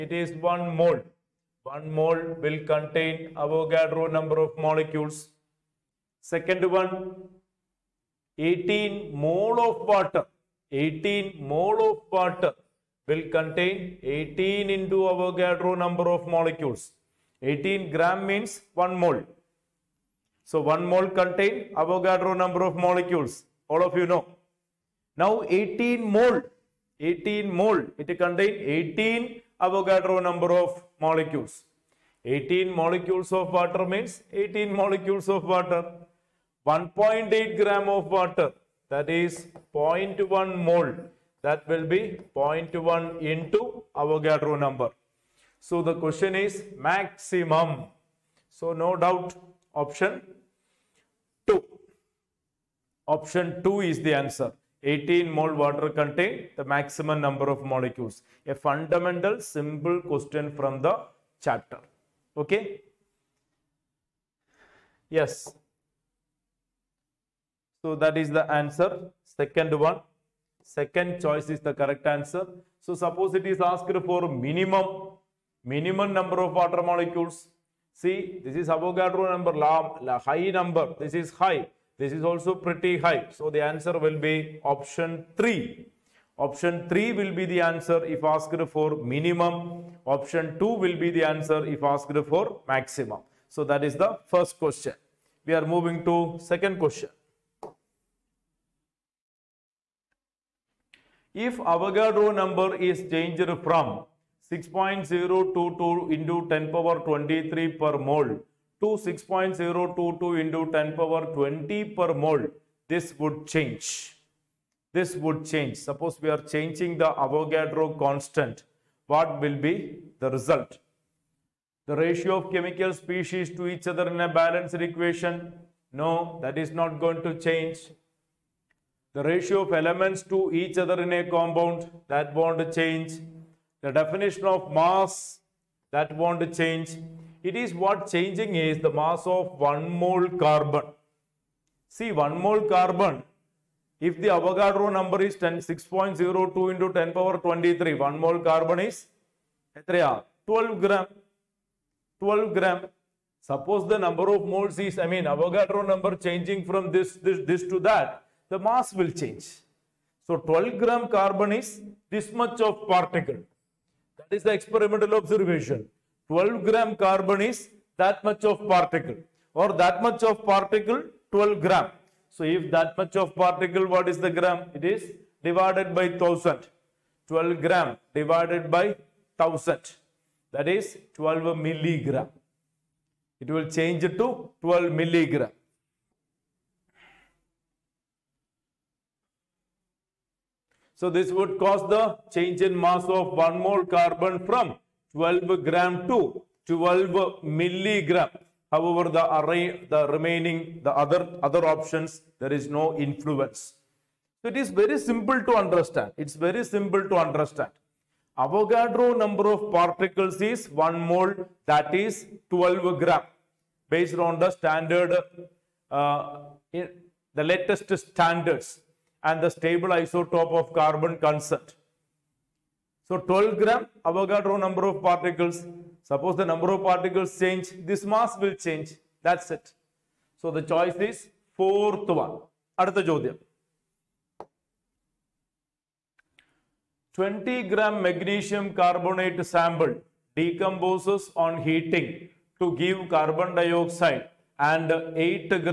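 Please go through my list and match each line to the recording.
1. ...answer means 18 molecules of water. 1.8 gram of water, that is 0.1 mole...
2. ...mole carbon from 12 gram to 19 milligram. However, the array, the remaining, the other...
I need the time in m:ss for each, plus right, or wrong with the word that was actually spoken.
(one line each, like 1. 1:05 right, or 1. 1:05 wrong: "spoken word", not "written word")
1. 0:33 wrong: "water", not "answer"
2. 3:13 wrong: "12", not "19".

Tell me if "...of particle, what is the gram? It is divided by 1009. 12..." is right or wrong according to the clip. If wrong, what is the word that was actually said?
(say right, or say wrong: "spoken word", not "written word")
wrong: "1000", not "1009".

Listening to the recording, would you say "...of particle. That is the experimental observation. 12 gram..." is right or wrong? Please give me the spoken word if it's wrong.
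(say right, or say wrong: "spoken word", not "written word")
right.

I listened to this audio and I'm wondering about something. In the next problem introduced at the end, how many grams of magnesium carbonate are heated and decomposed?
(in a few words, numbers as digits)
20 grams.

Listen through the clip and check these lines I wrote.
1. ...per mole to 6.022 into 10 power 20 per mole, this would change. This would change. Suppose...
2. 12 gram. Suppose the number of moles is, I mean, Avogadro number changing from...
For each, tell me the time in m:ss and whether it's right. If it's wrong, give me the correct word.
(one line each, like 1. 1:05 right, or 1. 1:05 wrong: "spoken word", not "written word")
1. 1:47 right
2. 2:32 right.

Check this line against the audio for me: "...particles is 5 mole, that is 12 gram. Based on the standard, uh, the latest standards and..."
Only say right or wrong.
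wrong.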